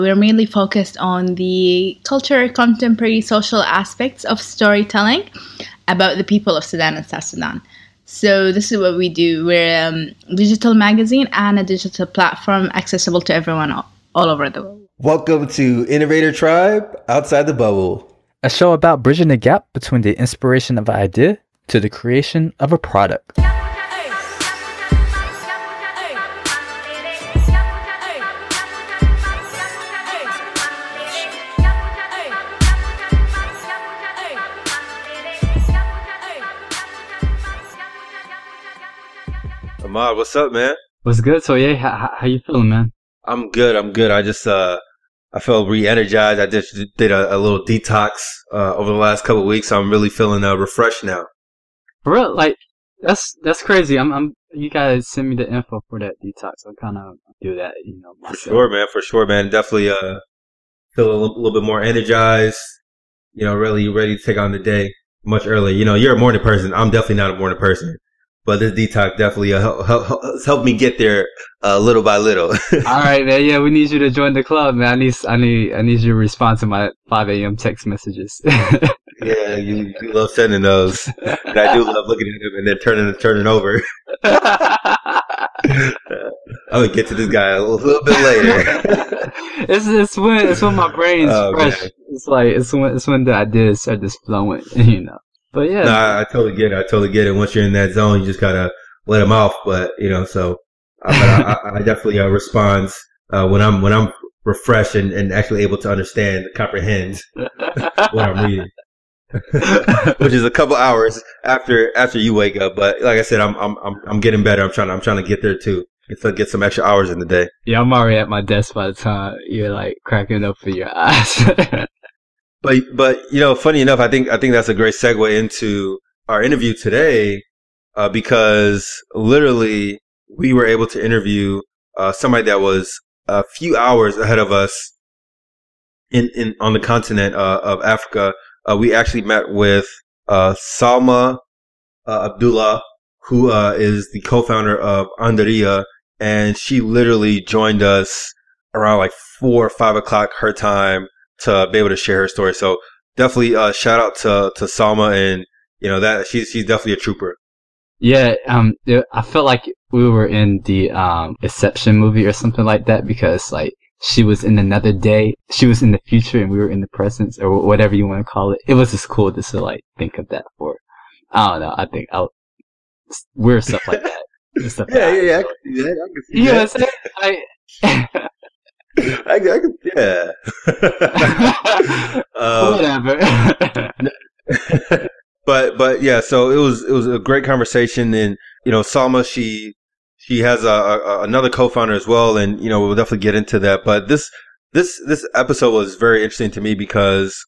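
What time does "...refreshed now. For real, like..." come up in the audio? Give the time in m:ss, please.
0:50.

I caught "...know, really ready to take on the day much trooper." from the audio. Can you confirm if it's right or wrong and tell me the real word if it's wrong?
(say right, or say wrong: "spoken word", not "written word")
wrong: "earlier", not "trooper".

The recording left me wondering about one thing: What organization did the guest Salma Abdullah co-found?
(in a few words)
Andariya.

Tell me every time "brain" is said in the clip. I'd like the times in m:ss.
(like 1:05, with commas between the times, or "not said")
1:30.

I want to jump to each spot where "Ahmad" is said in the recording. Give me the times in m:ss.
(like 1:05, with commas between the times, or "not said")
0:39.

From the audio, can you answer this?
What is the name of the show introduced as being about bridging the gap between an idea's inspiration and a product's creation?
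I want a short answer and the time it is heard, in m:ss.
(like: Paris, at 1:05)
Innovator Tribe Outside the Bubble, at 0:15.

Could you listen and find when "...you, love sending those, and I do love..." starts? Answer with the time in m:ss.
1:19.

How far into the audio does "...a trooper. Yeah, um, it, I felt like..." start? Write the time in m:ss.
2:36.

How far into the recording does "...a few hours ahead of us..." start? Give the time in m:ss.
2:13.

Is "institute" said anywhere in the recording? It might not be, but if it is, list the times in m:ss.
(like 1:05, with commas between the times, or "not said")
not said.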